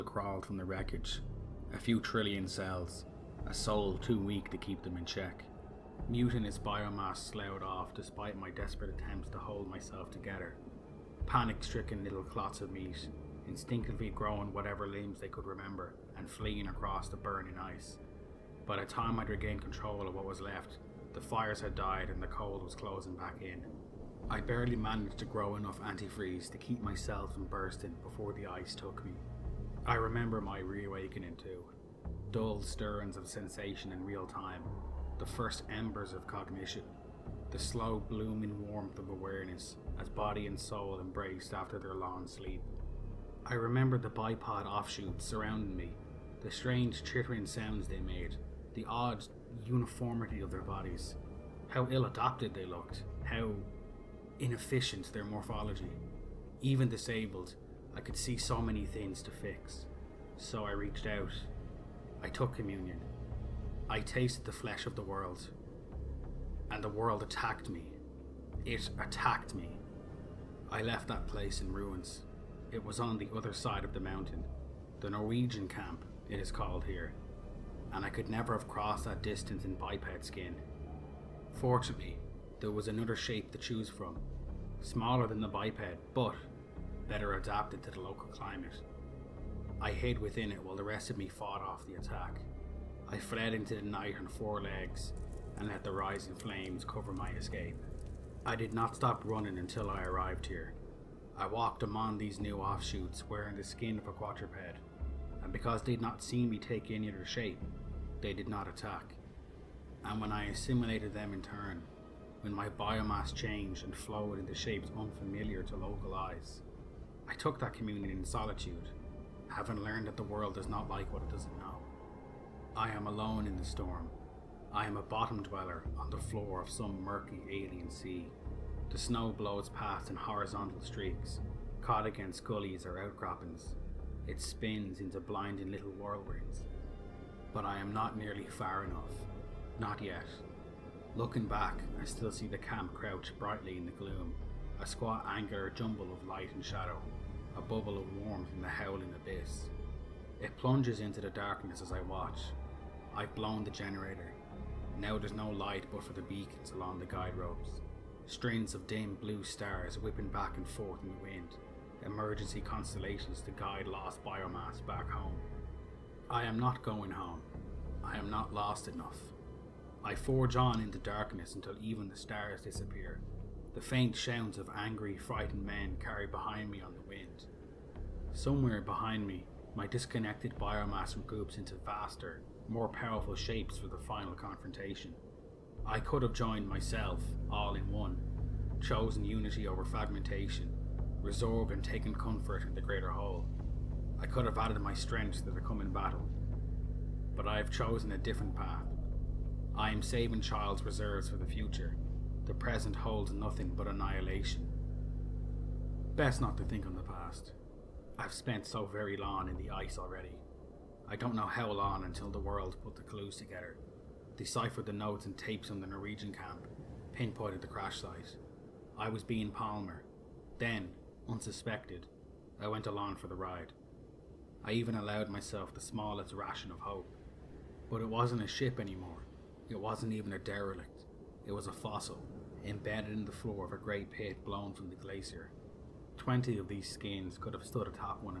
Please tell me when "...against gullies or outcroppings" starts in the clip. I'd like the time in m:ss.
2:12.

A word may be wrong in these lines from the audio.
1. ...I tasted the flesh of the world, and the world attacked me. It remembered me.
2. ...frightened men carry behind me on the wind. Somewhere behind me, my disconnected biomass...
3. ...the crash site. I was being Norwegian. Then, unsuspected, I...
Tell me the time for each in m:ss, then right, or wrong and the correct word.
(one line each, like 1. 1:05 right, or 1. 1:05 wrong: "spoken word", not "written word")
1. 1:03 wrong: "attacked", not "remembered"
2. 2:55 right
3. 3:37 wrong: "Palmer", not "Norwegian".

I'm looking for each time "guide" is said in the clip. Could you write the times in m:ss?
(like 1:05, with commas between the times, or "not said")
2:37, 2:43.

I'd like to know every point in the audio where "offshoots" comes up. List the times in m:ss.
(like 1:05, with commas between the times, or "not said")
0:44, 1:42.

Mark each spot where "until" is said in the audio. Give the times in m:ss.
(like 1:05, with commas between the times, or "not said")
1:39, 2:51, 3:32.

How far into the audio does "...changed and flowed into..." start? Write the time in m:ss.
1:53.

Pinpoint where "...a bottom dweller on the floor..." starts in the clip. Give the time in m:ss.
2:04.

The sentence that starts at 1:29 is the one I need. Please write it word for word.
I hid within it while the rest of me fought off the attack.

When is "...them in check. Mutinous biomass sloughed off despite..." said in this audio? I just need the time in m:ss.
0:04.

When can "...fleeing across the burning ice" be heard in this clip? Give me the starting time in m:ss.
0:16.